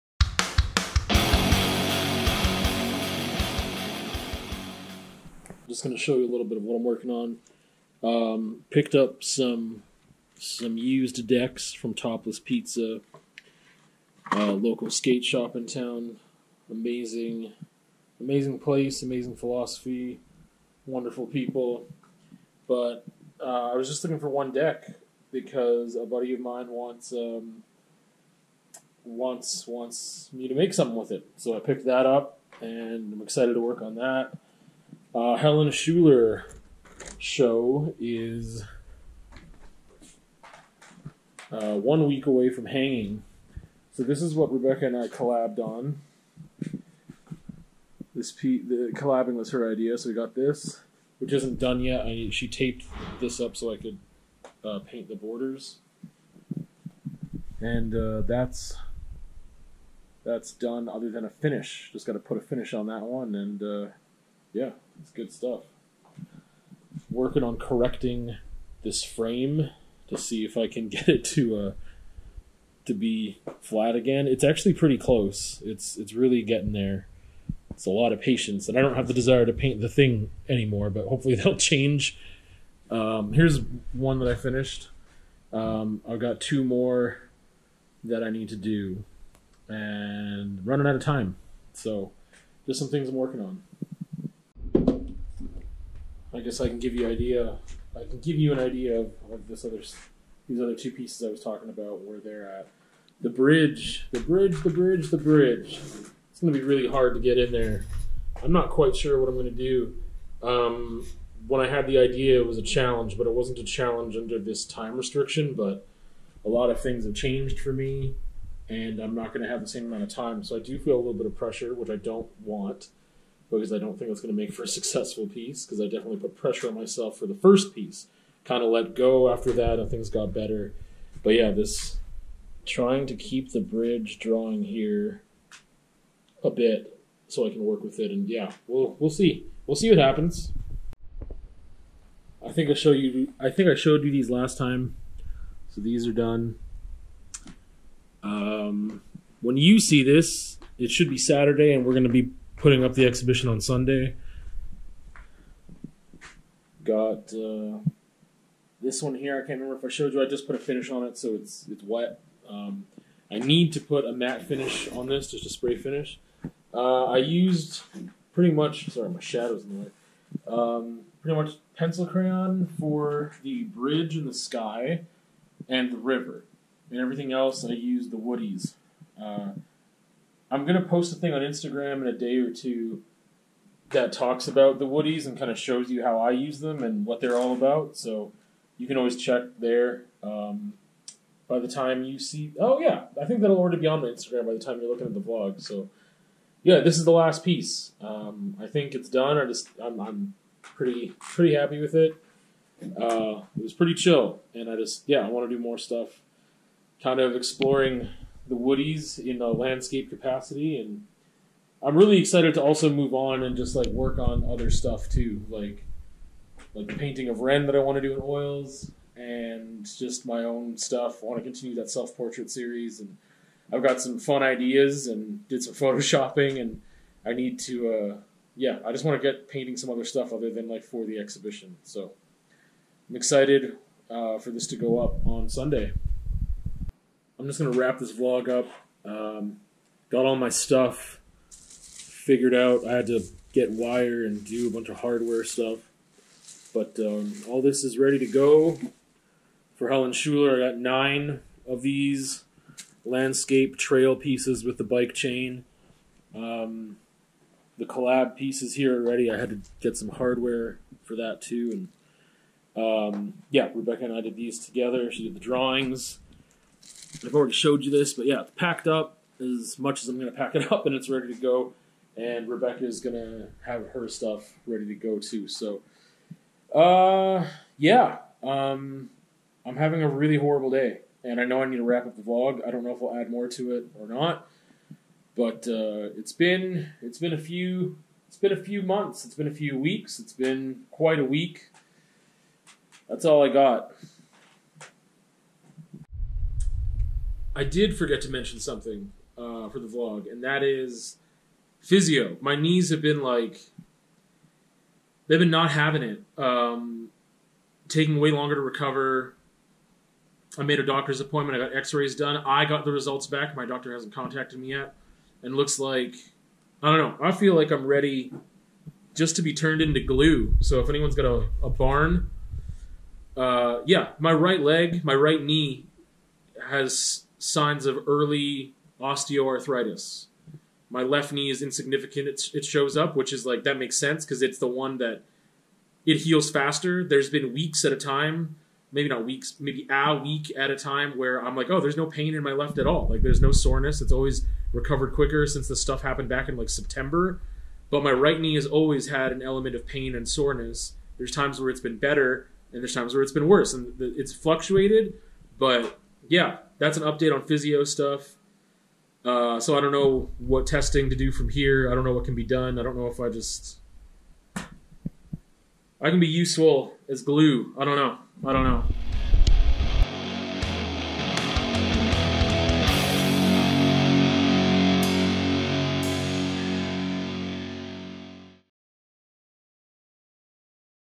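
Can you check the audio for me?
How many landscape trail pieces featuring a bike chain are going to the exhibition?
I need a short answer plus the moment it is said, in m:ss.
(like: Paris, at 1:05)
9, at 4:10.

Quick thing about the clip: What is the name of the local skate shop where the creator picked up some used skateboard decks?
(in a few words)
Topless Pizza.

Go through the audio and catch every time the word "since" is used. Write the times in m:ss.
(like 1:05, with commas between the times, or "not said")
5:45.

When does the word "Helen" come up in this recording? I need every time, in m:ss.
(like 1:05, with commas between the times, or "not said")
0:35, 4:09.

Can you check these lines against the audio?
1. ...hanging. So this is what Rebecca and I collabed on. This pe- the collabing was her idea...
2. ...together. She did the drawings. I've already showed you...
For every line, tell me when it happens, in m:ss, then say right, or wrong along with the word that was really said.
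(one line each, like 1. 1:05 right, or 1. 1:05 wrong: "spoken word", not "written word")
1. 0:42 right
2. 4:24 right.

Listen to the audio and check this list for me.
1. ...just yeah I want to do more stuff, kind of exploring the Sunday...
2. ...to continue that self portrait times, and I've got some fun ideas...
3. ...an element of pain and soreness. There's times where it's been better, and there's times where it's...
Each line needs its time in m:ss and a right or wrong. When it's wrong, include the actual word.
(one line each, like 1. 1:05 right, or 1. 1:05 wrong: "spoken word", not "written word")
1. 3:24 wrong: "Woodies", not "Sunday"
2. 3:41 wrong: "series", not "times"
3. 5:49 right.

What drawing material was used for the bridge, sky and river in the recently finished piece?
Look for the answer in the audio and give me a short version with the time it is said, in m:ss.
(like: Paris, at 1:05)
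pencil crayon, at 2:51.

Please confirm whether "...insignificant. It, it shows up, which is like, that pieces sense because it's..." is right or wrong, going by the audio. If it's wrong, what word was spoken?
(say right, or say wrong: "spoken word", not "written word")
wrong: "makes", not "pieces".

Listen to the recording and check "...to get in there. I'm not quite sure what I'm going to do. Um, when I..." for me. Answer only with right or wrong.
right.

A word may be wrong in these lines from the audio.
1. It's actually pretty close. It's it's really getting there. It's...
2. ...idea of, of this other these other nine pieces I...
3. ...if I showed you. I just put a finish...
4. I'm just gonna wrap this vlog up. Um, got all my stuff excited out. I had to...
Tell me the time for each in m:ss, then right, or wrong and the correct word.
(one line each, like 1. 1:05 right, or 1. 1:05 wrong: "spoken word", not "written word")
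1. 1:14 right
2. 1:38 wrong: "two", not "nine"
3. 2:39 right
4. 3:57 wrong: "figured", not "excited".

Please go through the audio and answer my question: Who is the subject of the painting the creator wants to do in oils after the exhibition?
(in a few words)
Ren.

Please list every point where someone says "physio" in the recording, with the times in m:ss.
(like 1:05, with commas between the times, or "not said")
5:01, 5:57.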